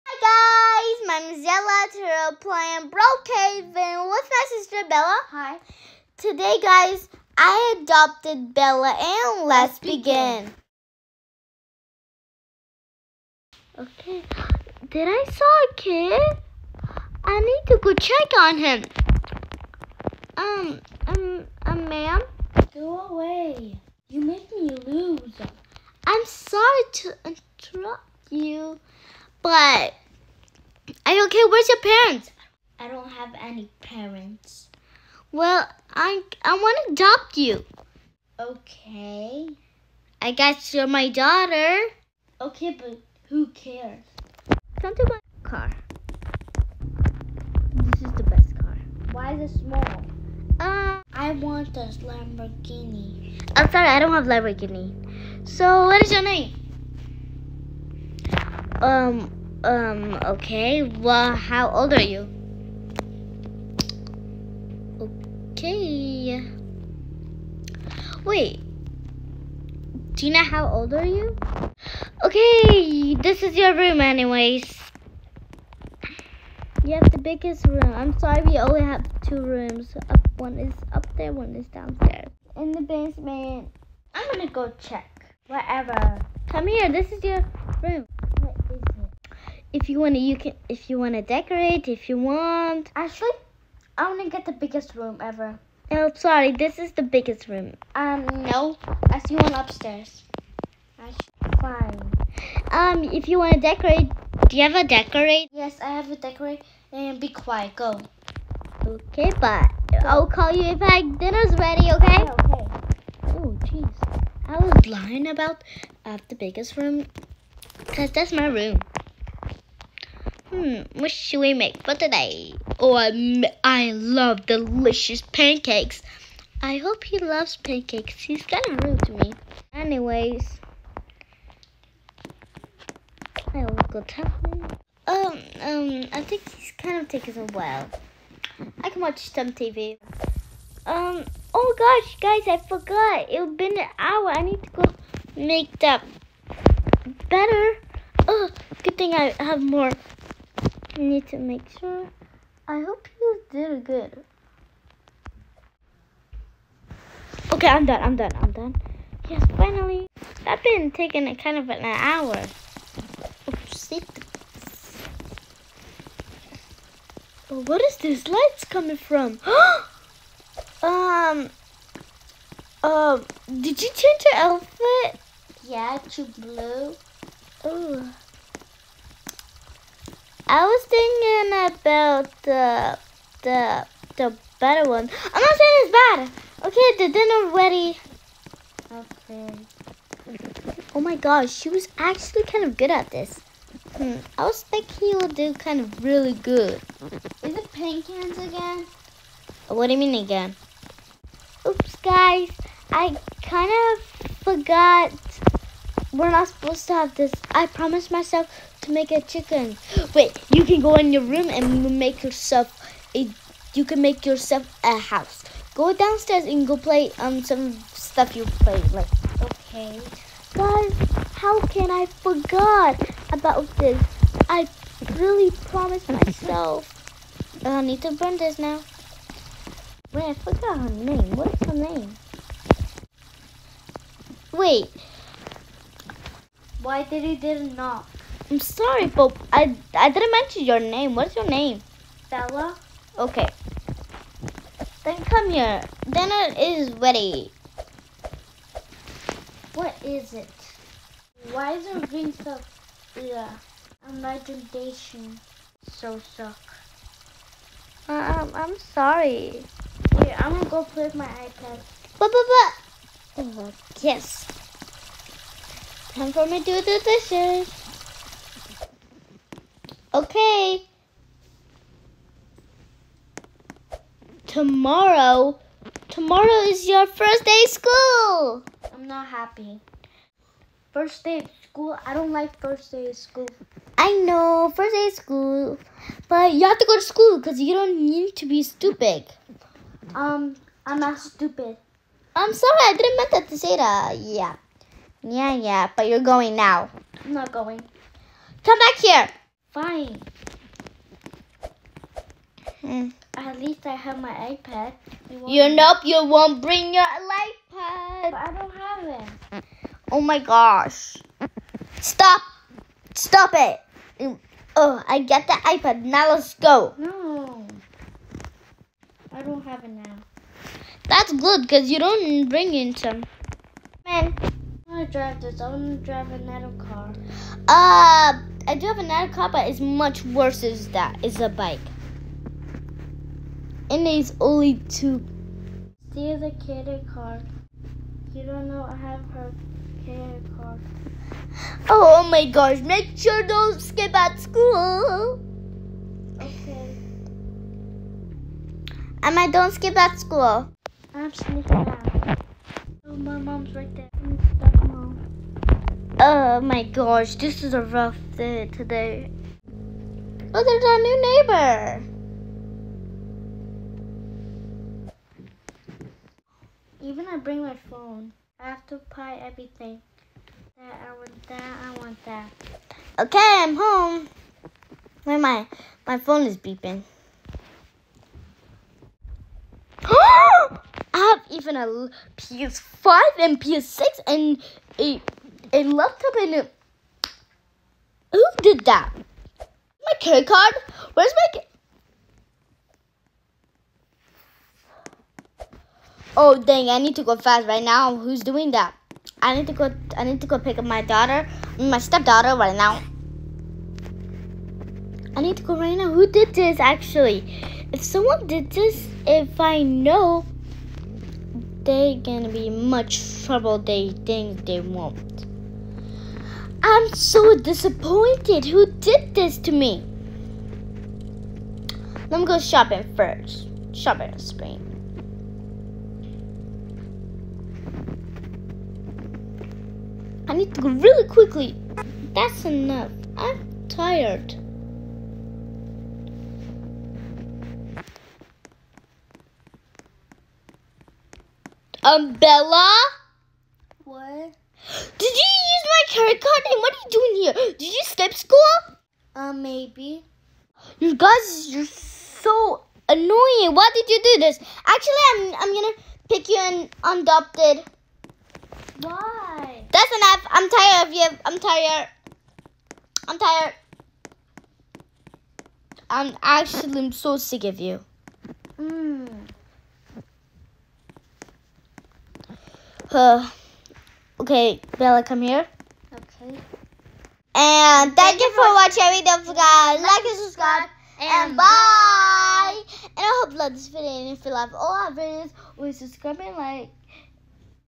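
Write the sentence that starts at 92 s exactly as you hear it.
Actually, I wanna get the biggest room ever.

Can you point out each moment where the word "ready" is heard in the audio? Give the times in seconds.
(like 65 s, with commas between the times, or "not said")
111 s, 187 s, 246 s.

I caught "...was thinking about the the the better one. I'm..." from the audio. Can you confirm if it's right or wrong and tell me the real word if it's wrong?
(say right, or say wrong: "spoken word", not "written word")
right.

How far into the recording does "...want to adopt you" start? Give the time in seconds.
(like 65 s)
36 s.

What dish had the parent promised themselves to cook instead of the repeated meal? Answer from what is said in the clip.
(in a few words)
Chicken.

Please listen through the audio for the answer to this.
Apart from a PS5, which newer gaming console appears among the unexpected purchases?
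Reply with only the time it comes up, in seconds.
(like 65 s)
383 s.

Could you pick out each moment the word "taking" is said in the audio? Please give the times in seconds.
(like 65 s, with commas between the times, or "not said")
137 s, 160 s.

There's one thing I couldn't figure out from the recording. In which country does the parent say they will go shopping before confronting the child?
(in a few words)
Spain.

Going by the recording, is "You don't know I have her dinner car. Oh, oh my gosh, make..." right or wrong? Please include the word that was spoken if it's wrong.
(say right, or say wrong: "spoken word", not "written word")
wrong: "cater", not "dinner".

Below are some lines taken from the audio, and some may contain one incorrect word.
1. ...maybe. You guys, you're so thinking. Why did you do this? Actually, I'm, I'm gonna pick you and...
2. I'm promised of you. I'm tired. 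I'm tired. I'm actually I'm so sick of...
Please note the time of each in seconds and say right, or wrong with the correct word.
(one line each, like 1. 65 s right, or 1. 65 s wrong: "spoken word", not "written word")
1. 449 s wrong: "annoying", not "thinking"
2. 460 s wrong: "tired", not "promised".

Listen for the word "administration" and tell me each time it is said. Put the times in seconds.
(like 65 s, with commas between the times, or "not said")
not said.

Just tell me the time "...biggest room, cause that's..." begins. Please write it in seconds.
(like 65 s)
116 s.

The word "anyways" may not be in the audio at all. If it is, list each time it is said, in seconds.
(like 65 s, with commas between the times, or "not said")
74 s, 129 s.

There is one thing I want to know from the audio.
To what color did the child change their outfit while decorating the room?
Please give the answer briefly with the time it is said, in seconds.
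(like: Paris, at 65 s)
Blue, at 176 s.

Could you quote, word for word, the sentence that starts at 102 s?
Um, if you wanna decorate, do you ever decorate?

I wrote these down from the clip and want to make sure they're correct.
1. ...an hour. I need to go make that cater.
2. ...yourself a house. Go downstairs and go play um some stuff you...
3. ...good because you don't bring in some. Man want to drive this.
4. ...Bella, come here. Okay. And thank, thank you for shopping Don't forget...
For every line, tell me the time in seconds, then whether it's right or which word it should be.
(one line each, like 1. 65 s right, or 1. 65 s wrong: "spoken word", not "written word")
1. 143 s wrong: "better", not "cater"
2. 214 s right
3. 321 s right
4. 474 s wrong: "watching", not "shopping".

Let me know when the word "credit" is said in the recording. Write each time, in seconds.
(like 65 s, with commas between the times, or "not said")
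390 s, 446 s.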